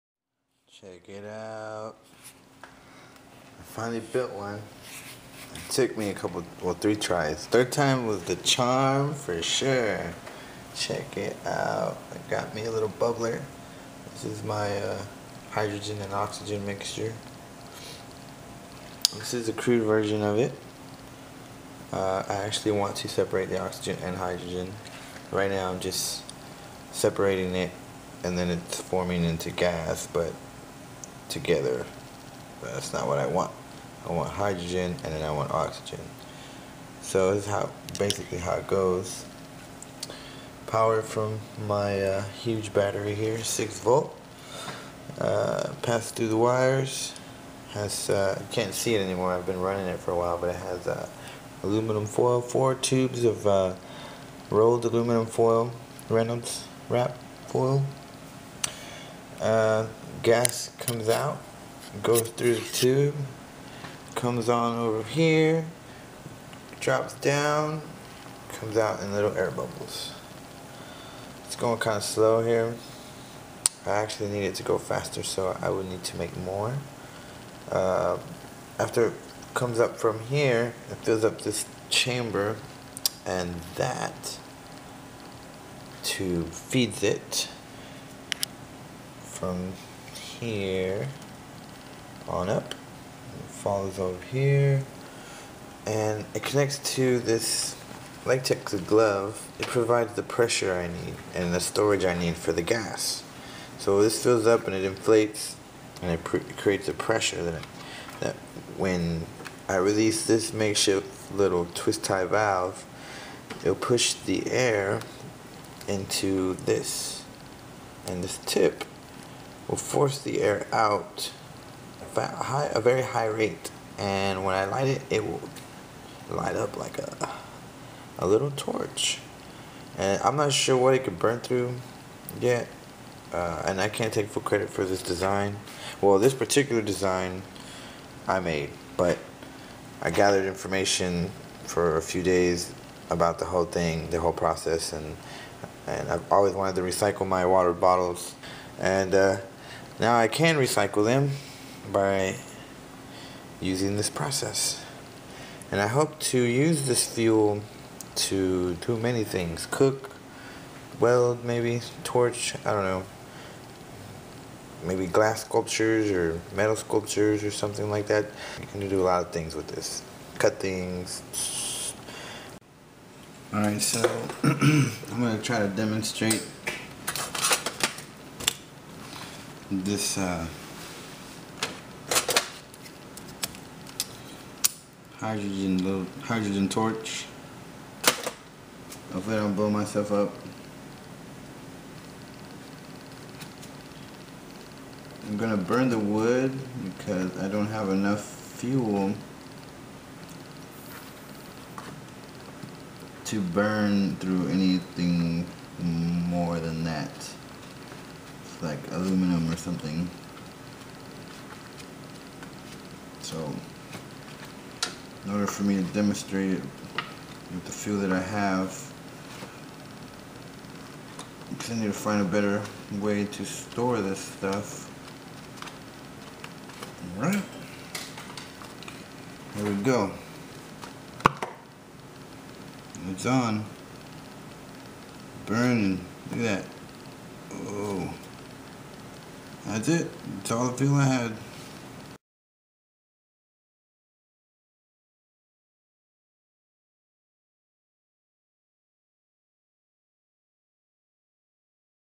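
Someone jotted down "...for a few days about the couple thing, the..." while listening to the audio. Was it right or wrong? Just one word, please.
wrong.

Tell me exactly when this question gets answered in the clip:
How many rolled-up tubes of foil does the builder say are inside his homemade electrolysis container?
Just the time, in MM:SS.
00:52.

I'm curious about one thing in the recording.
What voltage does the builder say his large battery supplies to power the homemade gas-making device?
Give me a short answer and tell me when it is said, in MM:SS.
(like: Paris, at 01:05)
6 volts, at 00:43.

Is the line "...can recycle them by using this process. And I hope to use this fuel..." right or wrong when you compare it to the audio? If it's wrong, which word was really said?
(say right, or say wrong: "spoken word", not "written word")
right.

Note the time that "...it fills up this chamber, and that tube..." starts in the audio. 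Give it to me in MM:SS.
01:20.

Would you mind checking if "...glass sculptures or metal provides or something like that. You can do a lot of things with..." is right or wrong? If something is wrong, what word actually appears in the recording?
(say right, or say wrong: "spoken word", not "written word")
wrong: "sculptures", not "provides".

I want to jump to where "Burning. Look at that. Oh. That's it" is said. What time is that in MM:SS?
03:55.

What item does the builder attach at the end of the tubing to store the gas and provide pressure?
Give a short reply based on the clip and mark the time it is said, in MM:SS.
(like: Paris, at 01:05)
latex glove, at 01:38.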